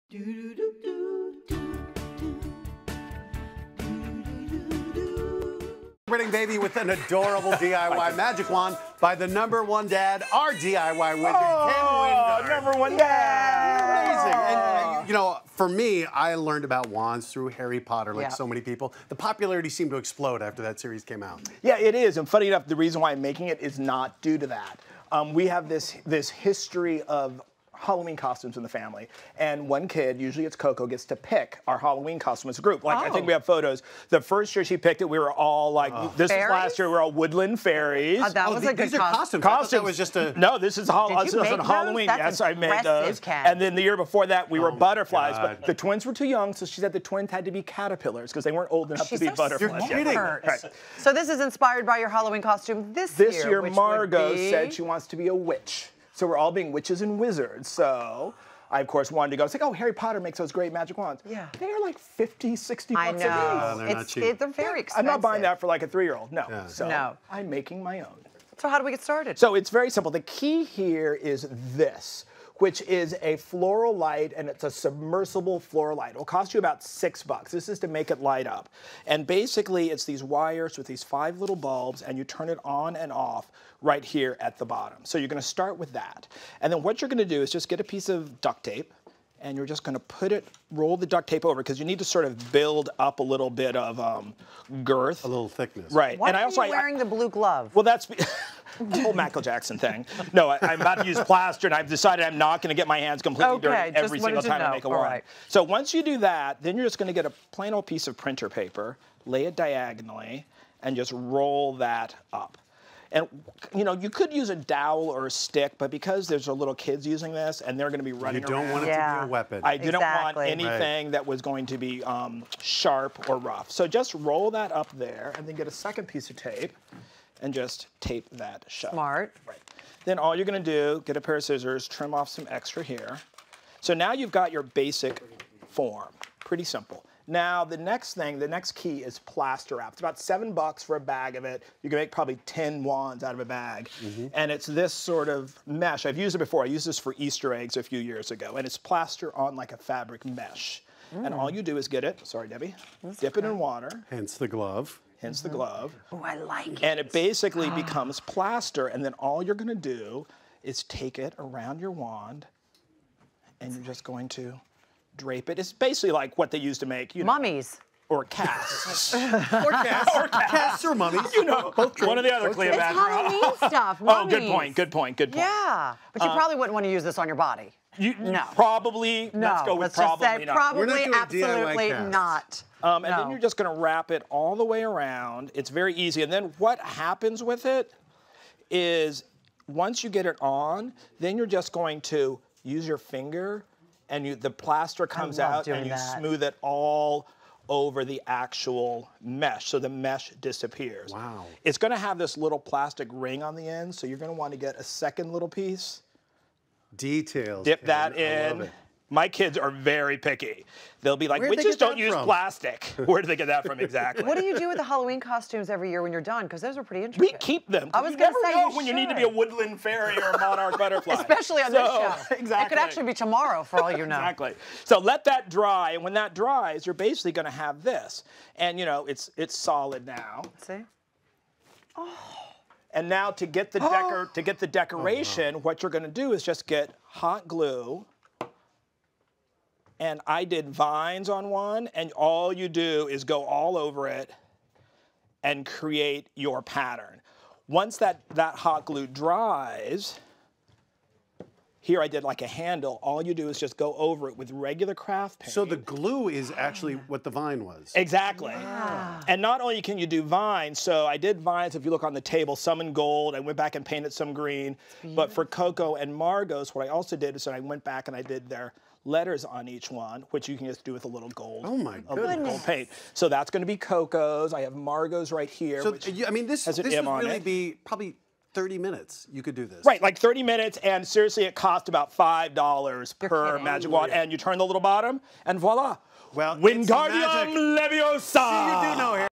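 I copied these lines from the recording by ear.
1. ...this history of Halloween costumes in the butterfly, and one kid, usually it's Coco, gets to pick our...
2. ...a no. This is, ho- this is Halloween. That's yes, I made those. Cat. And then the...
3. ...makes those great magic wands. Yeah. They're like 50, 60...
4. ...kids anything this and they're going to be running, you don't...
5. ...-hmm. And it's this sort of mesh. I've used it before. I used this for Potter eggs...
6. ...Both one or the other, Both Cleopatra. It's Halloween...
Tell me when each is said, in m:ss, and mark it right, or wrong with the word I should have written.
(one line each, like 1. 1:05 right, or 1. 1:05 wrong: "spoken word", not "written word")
1. 0:26 wrong: "family", not "butterfly"
2. 0:40 right
3. 1:00 right
4. 1:56 wrong: "using", not "anything"
5. 2:24 wrong: "Easter", not "Potter"
6. 2:51 right.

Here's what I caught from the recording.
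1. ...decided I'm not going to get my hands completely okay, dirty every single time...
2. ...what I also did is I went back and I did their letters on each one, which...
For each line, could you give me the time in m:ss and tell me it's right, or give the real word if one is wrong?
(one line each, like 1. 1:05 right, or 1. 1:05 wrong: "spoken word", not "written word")
1. 1:41 right
2. 4:26 right.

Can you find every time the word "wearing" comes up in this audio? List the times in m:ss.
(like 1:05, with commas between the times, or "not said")
1:36.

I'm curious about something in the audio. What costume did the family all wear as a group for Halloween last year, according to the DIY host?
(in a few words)
Woodland fairies.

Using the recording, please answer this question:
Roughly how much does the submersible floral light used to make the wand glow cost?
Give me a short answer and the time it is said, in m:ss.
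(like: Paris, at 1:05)
6 bucks, at 1:16.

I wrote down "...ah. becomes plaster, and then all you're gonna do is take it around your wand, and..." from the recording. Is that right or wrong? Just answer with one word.
right.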